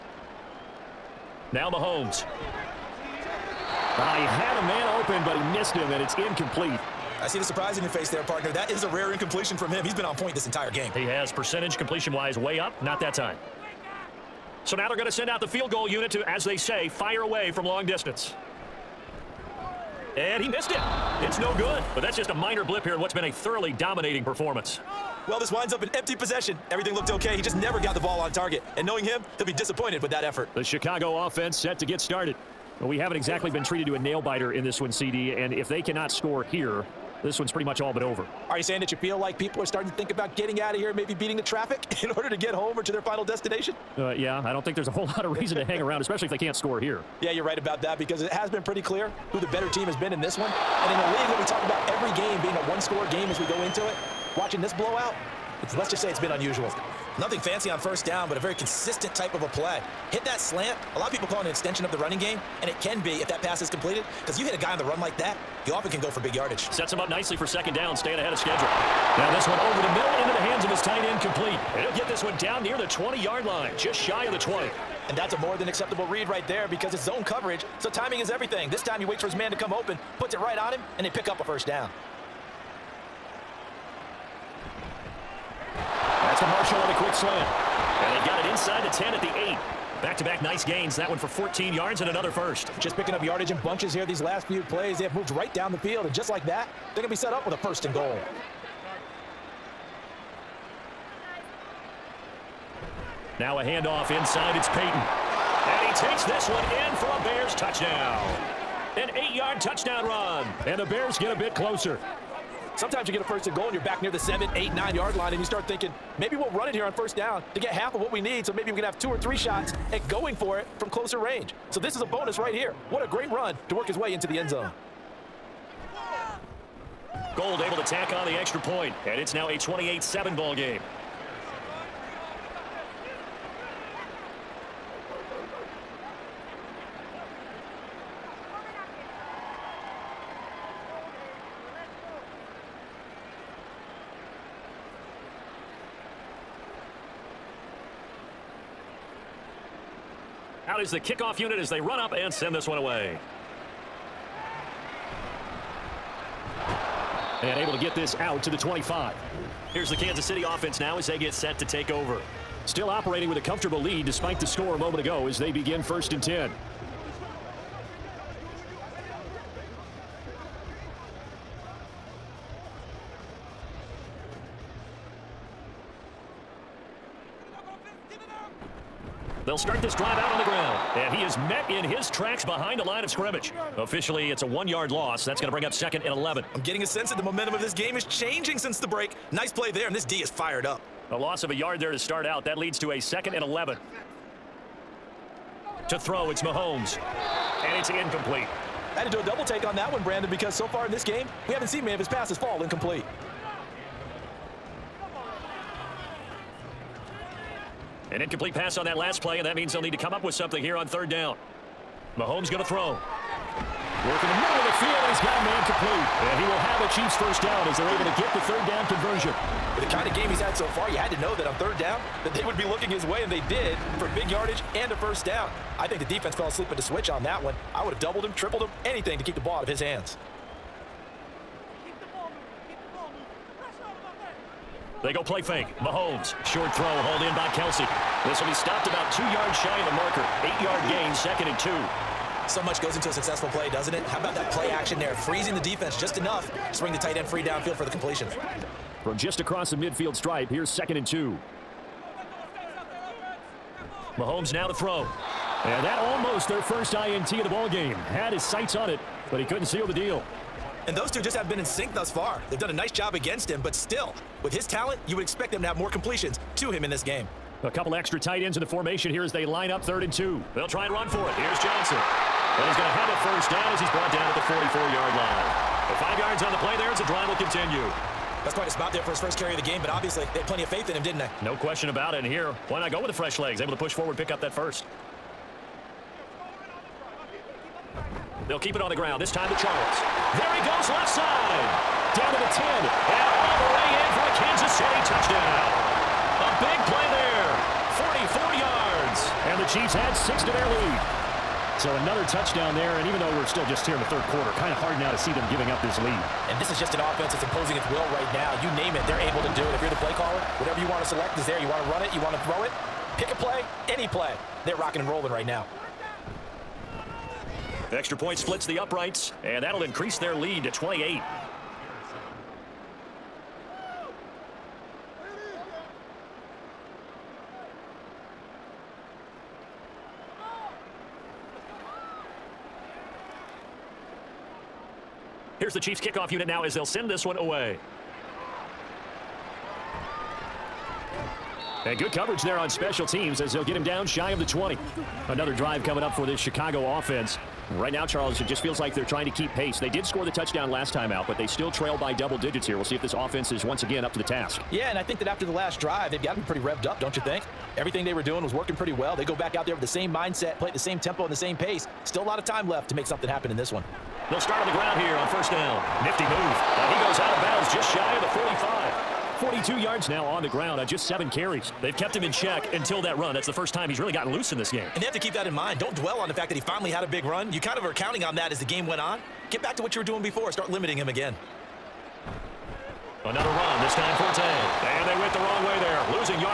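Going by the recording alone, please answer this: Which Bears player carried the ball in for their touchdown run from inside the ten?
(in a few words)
Payton.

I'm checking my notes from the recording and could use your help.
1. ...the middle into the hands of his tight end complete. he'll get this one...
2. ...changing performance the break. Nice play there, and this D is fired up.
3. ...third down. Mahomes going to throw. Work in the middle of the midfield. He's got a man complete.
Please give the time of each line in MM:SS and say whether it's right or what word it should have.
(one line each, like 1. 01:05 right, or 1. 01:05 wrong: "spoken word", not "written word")
1. 01:09 right
2. 03:08 wrong: "since", not "performance"
3. 03:30 wrong: "field", not "midfield".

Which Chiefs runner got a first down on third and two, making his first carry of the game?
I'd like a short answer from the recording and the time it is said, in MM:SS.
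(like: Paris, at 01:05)
Johnson, at 04:31.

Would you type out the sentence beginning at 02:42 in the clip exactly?
Still operating with a comfortable lead despite the score a moment ago as they begin first and 10.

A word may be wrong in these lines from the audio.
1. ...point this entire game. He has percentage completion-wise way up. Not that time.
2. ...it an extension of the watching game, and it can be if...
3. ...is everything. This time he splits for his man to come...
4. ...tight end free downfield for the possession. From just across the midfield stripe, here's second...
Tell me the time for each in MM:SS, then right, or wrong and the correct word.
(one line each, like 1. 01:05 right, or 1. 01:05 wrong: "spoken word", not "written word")
1. 00:10 right
2. 01:01 wrong: "running", not "watching"
3. 01:18 wrong: "waits", not "splits"
4. 04:06 wrong: "completion", not "possession".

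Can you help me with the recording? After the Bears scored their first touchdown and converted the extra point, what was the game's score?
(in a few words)
28-7.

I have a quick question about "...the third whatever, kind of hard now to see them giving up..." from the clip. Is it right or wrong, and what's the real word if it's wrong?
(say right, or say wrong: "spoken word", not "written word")
wrong: "quarter", not "whatever".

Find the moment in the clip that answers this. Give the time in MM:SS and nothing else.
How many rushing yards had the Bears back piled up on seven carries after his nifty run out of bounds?
06:09.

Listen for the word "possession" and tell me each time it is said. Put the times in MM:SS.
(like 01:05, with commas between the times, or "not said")
00:26.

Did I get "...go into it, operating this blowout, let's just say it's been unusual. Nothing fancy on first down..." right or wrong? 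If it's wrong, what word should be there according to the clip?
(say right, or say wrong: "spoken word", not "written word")
wrong: "watching", not "operating".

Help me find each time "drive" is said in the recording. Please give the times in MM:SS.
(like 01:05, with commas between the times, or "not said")
02:59, 04:37, 05:45, 05:55.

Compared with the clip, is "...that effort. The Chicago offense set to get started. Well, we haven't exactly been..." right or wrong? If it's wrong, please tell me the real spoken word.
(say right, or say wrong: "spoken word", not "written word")
right.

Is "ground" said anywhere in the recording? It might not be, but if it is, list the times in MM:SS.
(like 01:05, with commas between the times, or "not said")
03:00, 04:48, 06:04, 06:10.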